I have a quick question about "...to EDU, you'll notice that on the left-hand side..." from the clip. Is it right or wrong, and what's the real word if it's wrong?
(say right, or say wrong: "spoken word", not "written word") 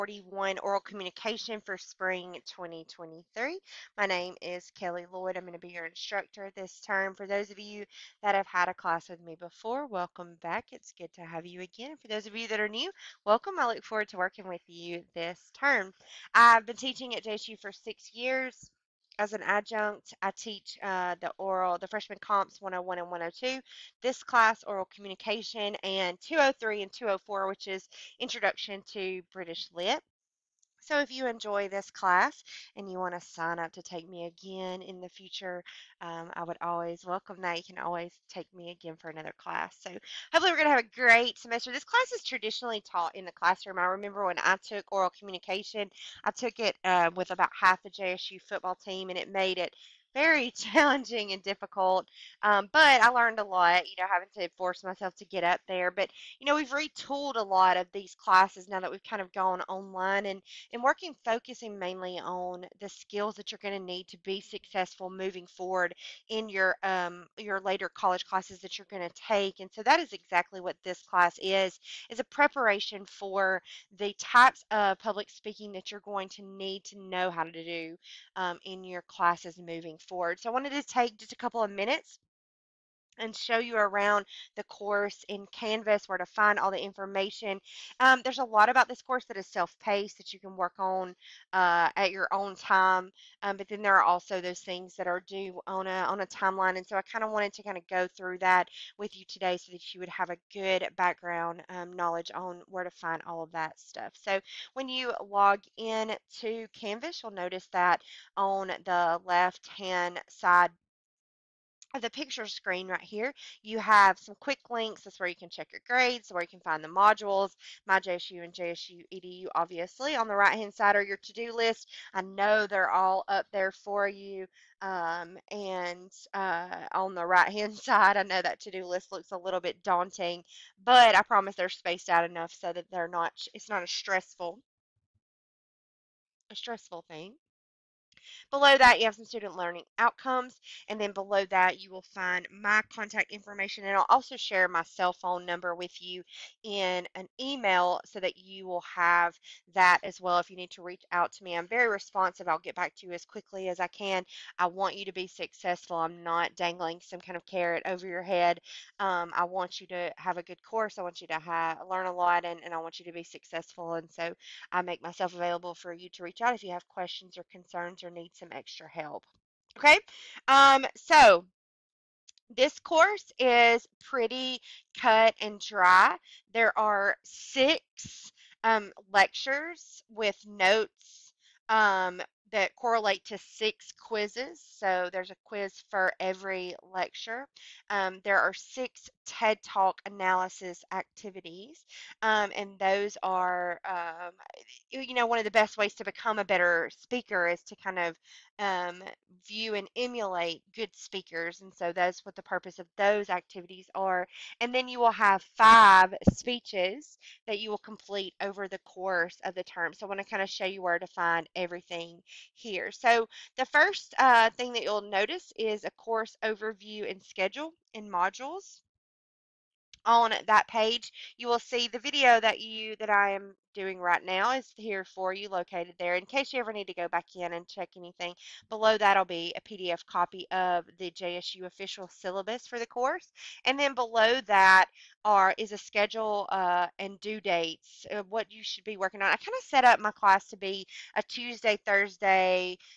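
wrong: "Canvas", not "EDU".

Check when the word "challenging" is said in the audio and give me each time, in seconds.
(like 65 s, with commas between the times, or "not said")
50 s.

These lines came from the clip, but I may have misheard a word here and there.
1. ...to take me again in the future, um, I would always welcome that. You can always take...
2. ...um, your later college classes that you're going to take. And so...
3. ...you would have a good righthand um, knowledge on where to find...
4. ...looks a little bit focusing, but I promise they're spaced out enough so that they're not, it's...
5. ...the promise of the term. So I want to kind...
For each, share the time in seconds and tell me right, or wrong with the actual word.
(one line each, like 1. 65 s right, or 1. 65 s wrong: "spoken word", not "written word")
1. 33 s right
2. 66 s right
3. 99 s wrong: "background", not "righthand"
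4. 129 s wrong: "daunting", not "focusing"
5. 208 s wrong: "course", not "promise".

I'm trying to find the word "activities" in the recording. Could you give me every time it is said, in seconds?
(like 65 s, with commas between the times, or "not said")
190 s, 203 s.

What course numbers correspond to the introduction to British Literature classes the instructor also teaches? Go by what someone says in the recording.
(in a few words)
203 and 204.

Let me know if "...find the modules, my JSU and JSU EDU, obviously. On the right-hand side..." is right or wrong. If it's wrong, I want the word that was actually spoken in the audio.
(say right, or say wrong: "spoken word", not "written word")
right.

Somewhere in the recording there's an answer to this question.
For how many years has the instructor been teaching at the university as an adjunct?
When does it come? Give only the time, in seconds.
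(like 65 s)
17 s.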